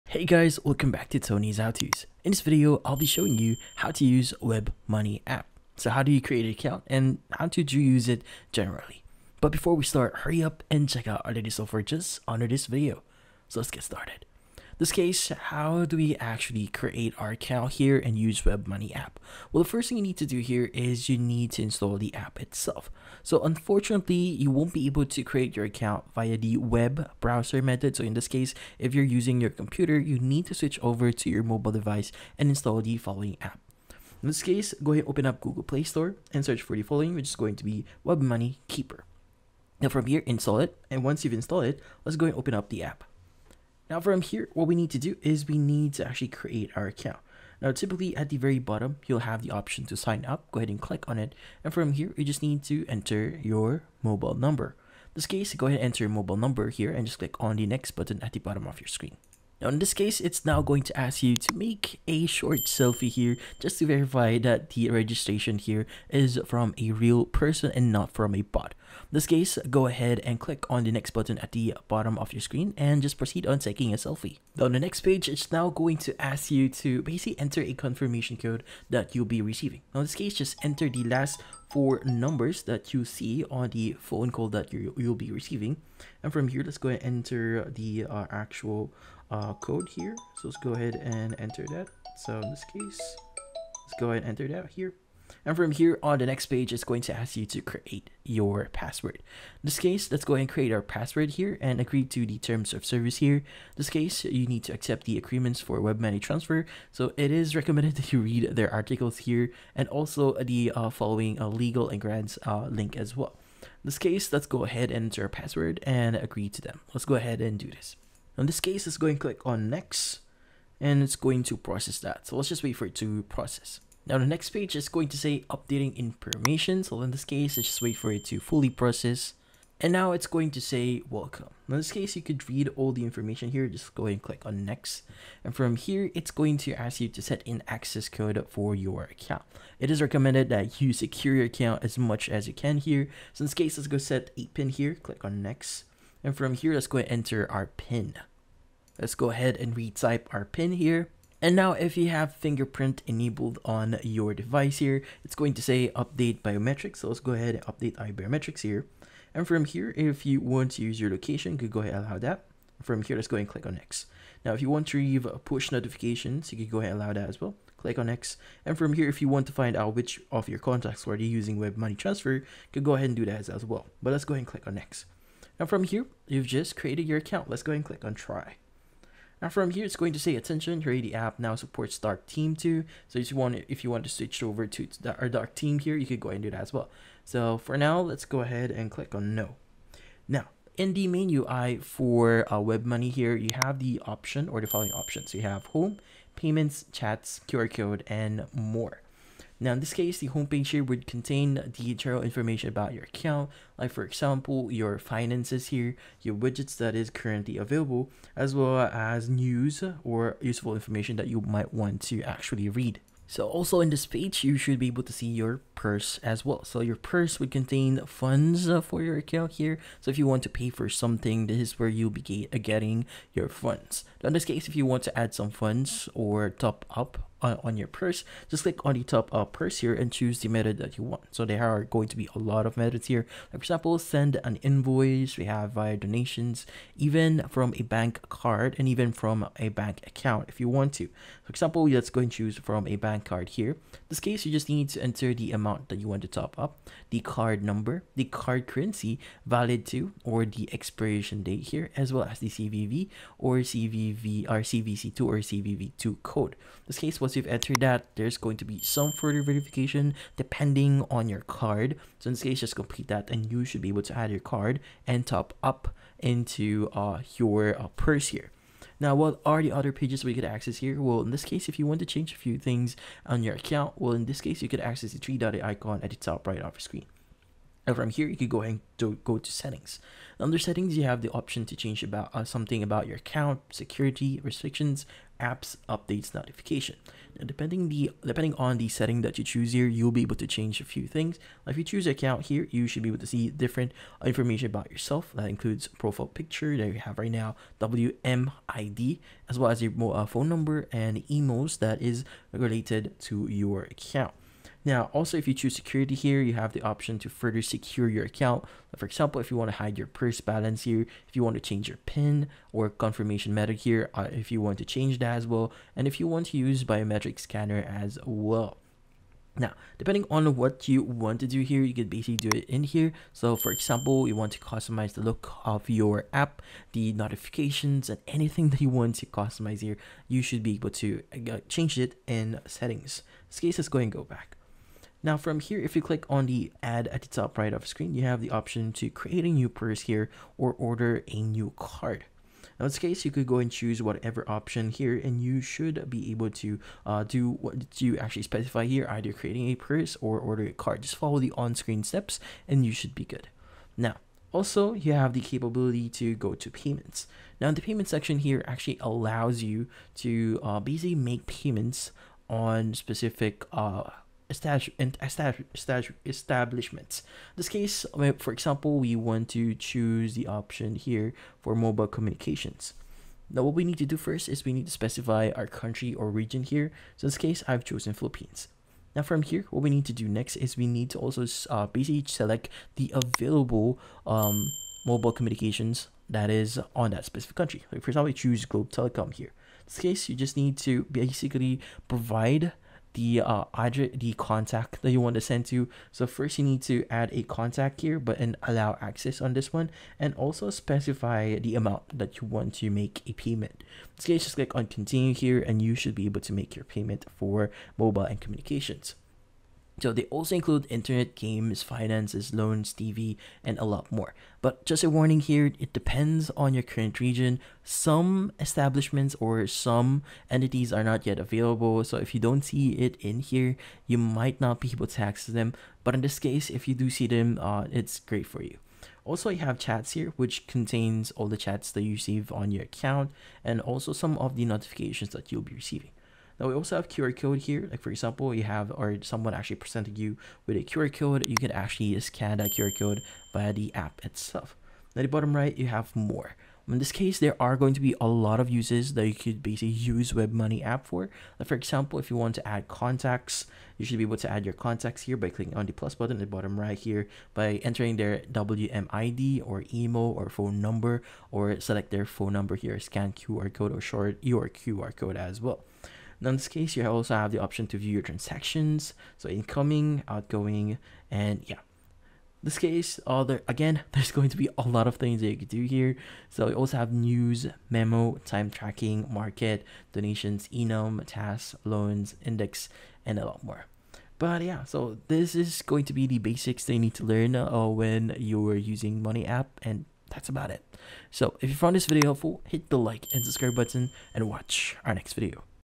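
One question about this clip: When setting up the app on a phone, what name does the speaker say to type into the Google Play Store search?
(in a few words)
Web Money Keeper.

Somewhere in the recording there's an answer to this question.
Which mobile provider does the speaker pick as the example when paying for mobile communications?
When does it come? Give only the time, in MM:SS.
06:28.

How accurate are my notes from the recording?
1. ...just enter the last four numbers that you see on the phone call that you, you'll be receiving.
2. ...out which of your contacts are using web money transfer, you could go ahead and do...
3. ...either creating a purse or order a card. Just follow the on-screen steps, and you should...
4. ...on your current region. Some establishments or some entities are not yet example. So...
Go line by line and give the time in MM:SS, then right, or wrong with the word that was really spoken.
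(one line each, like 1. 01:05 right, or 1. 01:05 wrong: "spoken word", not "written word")
1. 01:20 right
2. 02:49 right
3. 05:49 right
4. 06:56 wrong: "available", not "example".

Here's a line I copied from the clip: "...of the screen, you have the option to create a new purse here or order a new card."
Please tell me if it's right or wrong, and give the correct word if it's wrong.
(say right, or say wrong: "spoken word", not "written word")
right.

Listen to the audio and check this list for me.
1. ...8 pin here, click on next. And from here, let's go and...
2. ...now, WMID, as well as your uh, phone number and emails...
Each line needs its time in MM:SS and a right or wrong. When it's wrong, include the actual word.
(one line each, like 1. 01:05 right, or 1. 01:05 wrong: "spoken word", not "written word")
1. 02:24 right
2. 04:57 right.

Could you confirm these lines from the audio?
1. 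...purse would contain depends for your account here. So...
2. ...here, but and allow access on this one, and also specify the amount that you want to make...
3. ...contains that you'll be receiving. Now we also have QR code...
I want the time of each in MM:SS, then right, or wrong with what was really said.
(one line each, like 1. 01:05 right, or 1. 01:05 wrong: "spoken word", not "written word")
1. 03:36 wrong: "funds", not "depends"
2. 06:38 right
3. 07:14 wrong: "notifications", not "contains".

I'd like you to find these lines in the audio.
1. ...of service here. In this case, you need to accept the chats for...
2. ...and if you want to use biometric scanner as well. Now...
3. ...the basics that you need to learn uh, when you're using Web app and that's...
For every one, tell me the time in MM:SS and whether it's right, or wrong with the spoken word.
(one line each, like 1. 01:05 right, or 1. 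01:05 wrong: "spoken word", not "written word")
1. 01:42 wrong: "agreements", not "chats"
2. 05:15 right
3. 08:06 wrong: "Money", not "Web".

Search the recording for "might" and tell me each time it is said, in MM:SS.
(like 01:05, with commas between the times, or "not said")
03:31, 07:04.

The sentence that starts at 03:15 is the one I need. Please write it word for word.
You have home, payments, chats, QR code, and more.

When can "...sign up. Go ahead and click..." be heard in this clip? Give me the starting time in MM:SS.
00:49.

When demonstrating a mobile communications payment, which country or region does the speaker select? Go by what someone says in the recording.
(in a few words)
Philippines.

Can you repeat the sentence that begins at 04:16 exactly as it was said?
This case was once you've entered that, there's going to be some further verification depending on your card.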